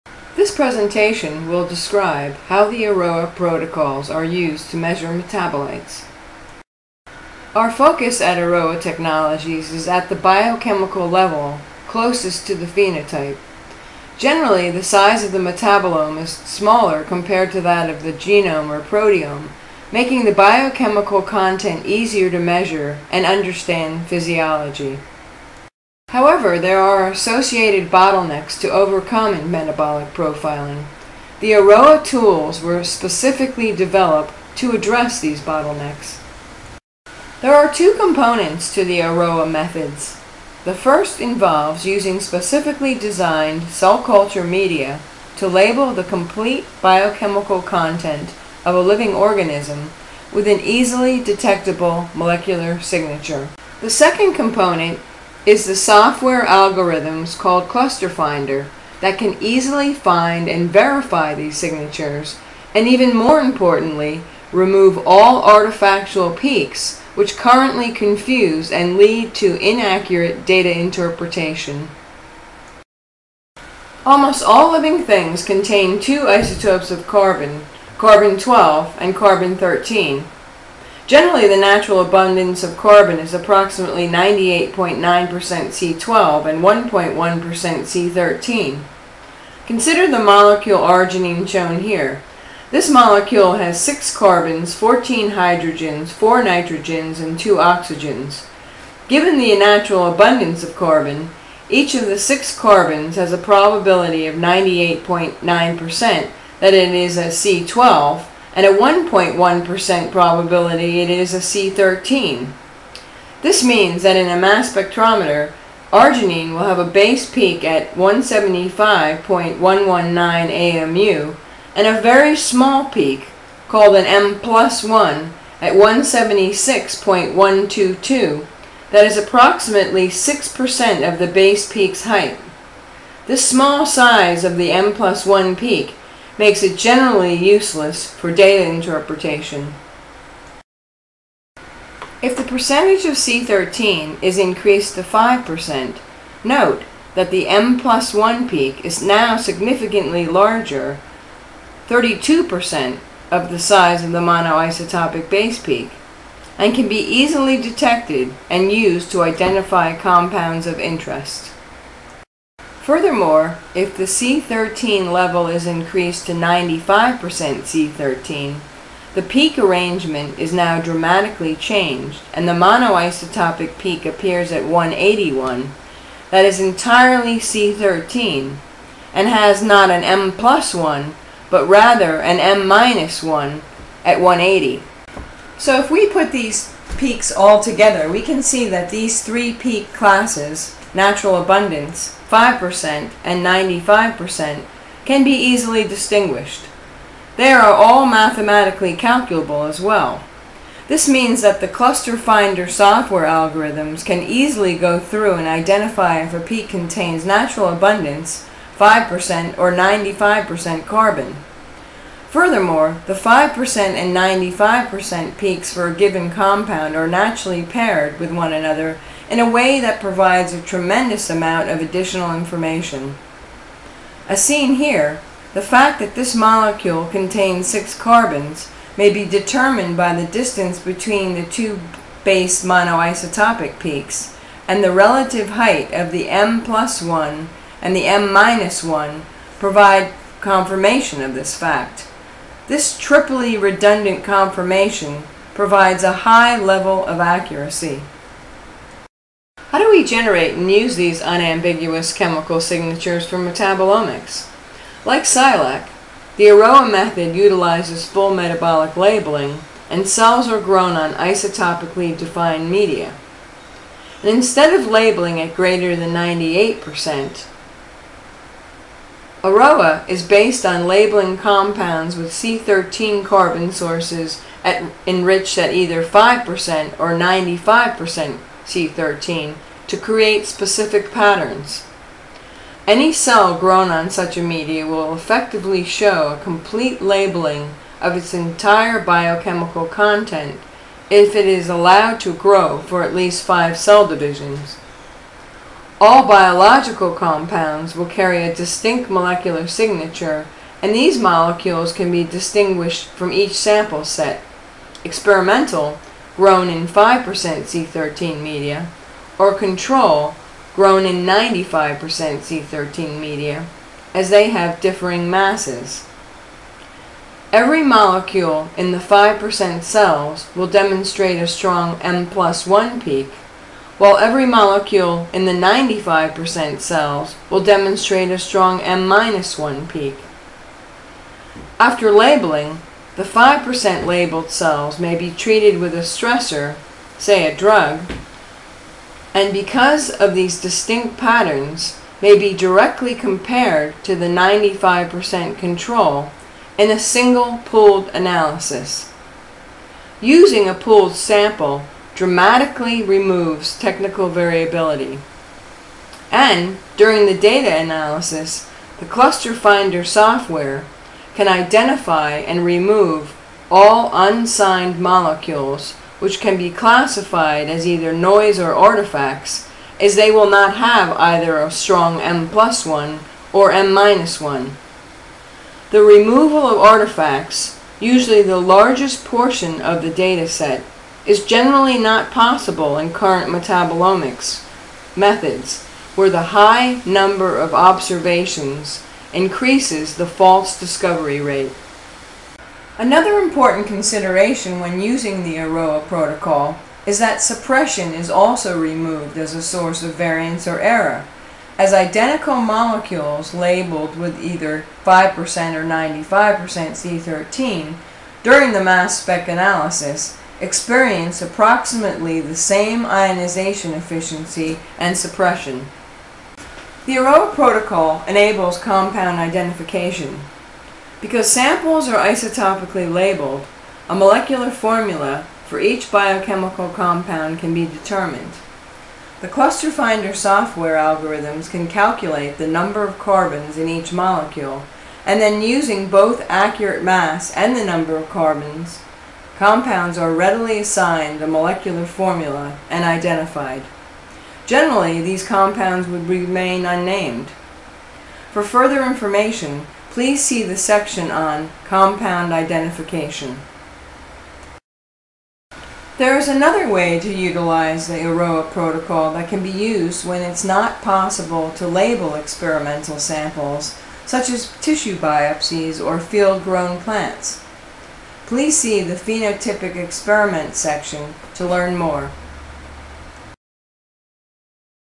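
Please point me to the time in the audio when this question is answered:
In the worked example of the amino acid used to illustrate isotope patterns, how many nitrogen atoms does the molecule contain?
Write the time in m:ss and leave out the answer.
1:36.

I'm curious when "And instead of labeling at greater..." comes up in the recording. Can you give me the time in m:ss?
4:24.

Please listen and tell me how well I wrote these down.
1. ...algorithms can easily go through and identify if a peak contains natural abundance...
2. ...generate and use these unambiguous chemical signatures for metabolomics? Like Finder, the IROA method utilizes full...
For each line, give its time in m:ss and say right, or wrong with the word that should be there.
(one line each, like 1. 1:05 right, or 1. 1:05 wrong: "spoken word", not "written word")
1. 3:23 right
2. 4:10 wrong: "Silac", not "Finder".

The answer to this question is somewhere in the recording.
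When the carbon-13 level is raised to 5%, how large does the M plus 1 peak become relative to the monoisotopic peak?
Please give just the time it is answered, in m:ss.
2:31.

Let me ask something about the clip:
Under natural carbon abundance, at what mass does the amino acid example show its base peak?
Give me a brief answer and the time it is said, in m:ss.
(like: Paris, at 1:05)
175.119 AMU, at 1:57.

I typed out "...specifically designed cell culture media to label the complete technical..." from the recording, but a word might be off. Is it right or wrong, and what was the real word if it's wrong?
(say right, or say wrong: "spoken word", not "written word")
wrong: "biochemical", not "technical".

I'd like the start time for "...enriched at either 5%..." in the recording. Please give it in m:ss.
4:35.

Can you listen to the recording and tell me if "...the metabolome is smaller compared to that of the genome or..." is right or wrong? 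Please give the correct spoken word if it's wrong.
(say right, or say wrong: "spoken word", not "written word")
right.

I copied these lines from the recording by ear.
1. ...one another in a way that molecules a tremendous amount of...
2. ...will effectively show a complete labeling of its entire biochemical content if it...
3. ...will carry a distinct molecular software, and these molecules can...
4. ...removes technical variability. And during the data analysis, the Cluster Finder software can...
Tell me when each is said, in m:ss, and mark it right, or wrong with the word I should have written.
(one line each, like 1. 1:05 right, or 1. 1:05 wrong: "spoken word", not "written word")
1. 3:38 wrong: "provides", not "molecules"
2. 4:44 right
3. 4:57 wrong: "signature", not "software"
4. 5:53 right.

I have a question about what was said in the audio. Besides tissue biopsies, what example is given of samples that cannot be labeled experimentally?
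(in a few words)
field-grown plants.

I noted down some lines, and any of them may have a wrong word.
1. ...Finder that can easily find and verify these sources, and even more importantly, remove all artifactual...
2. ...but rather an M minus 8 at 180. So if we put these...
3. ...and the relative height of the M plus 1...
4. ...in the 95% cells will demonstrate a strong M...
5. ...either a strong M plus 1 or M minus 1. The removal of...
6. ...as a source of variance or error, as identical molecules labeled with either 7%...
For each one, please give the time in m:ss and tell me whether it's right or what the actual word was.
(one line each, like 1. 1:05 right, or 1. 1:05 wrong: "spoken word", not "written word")
1. 0:58 wrong: "signatures", not "sources"
2. 3:01 wrong: "1", not "8"
3. 3:54 right
4. 5:25 right
5. 6:11 right
6. 6:39 wrong: "5", not "7".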